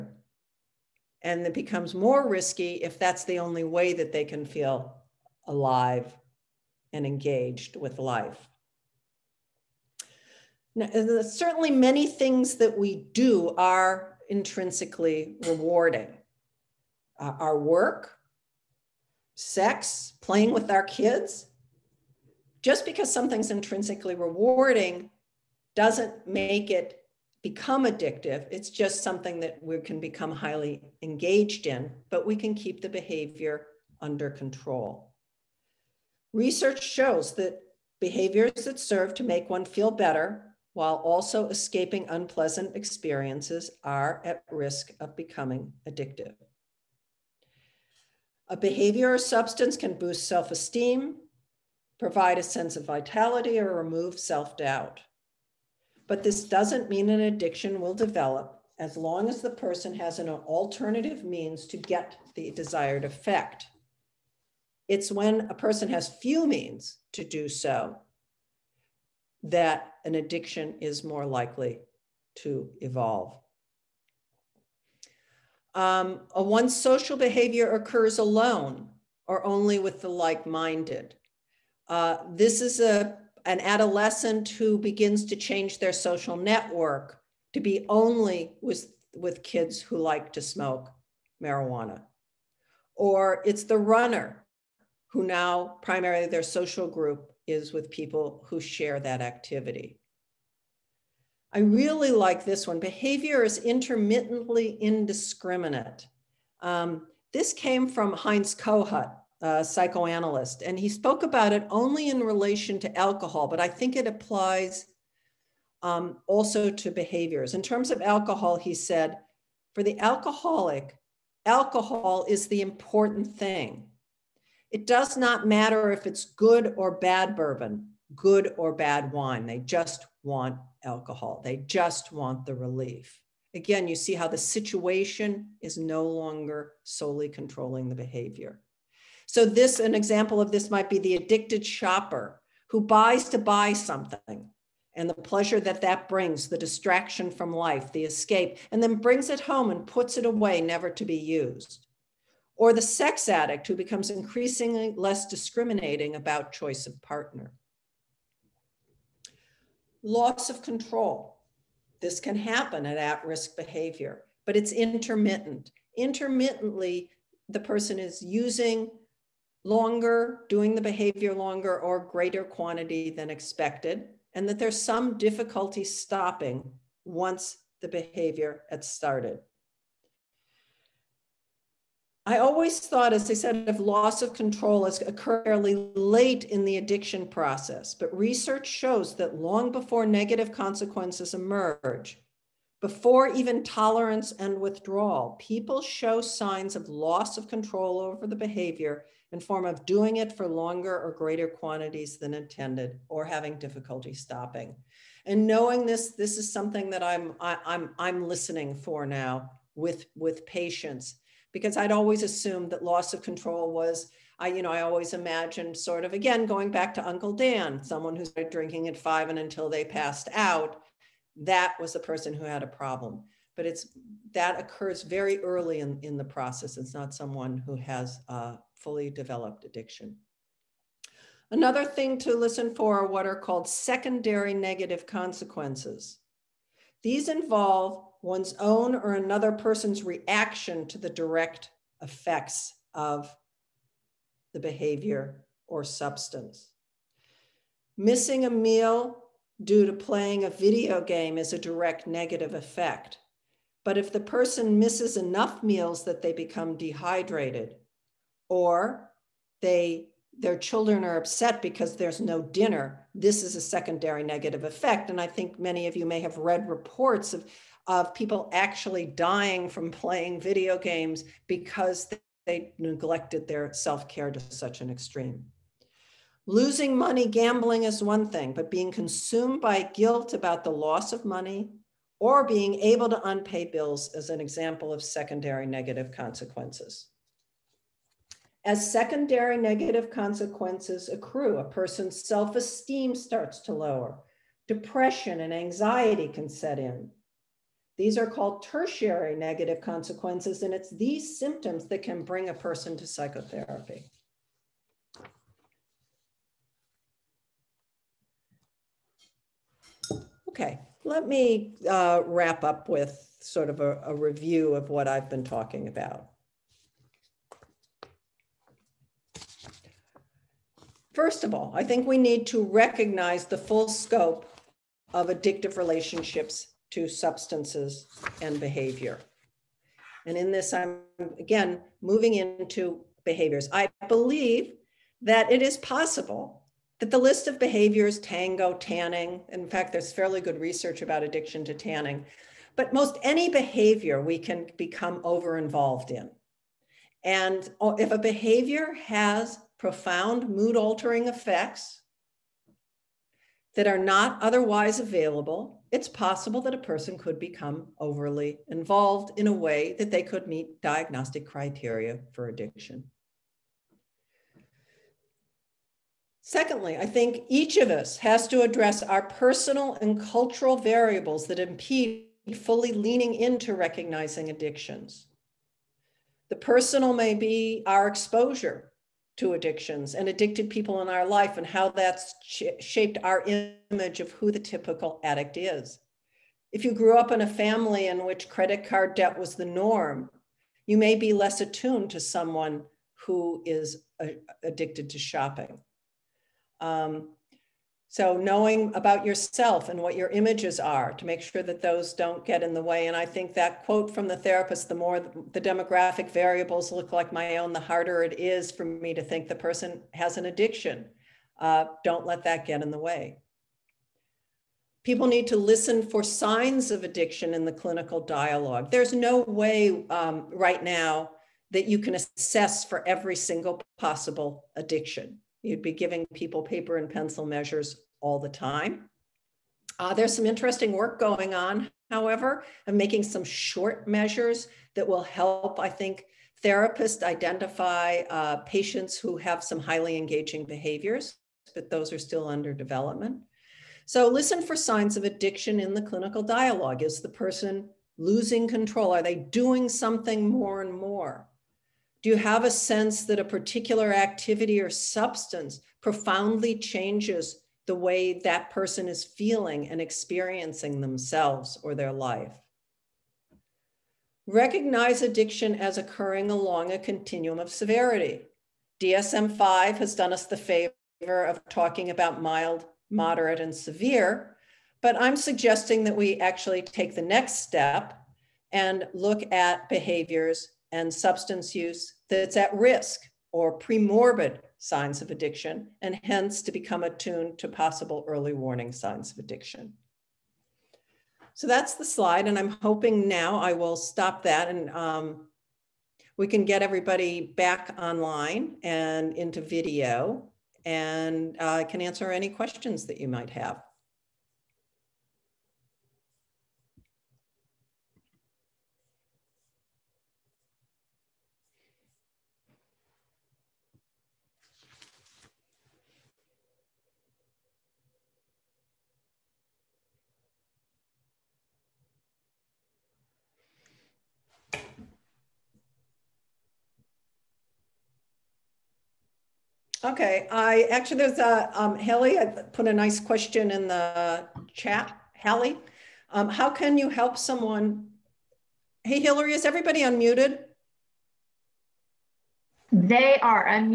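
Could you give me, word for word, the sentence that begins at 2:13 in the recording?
Again, you see how the situation is no longer solely controlling the behavior.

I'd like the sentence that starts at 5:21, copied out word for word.
First of all, I think we need to recognize the full scope of addictive relationships to substances and behavior.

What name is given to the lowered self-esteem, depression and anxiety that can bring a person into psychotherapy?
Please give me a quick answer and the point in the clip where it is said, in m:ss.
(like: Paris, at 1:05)
Tertiary negative consequences, at 4:58.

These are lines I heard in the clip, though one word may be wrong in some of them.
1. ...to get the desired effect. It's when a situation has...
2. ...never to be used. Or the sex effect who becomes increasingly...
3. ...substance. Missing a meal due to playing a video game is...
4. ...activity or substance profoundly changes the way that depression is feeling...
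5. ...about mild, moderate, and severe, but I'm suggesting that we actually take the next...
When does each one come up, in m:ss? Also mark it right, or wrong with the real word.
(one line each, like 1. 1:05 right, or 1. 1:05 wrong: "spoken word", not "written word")
1. 1:01 wrong: "person", not "situation"
2. 2:30 wrong: "addict", not "effect"
3. 4:05 right
4. 7:34 wrong: "person", not "depression"
5. 7:52 right.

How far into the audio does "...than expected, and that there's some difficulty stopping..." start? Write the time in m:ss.
2:53.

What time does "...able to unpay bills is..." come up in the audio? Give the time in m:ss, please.
4:42.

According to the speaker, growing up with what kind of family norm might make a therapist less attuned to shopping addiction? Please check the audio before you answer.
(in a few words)
Credit card debt.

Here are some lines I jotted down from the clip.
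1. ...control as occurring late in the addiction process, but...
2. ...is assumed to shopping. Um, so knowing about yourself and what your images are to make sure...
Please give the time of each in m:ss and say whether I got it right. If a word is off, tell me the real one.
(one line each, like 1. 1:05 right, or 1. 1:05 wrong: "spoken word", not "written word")
1. 3:04 right
2. 6:33 wrong: "addicted", not "assumed".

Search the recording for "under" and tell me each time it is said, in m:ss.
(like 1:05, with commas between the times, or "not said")
0:34, 7:22.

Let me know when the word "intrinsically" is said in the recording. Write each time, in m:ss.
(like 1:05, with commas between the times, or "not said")
0:14, 0:23.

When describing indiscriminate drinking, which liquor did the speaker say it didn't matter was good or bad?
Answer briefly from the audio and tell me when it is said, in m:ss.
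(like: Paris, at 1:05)
Bourbon, at 2:07.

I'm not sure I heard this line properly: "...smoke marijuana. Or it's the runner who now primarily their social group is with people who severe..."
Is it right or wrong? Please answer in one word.
wrong.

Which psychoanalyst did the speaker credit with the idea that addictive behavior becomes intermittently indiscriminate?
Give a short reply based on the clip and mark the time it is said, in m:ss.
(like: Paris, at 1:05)
Heinz Kohut, at 1:48.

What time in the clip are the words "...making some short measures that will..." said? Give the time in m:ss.
7:12.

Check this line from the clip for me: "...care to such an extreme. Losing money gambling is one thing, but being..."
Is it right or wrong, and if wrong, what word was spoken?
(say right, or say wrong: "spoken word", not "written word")
right.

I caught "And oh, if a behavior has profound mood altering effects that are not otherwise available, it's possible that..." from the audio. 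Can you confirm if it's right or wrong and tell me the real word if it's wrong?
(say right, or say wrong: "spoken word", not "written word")
right.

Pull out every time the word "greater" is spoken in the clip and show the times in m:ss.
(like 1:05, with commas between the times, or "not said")
2:52, 3:21.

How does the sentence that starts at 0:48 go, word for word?
A behavior or substance can boost self esteem, provide a sense of vitality, or remove self doubt.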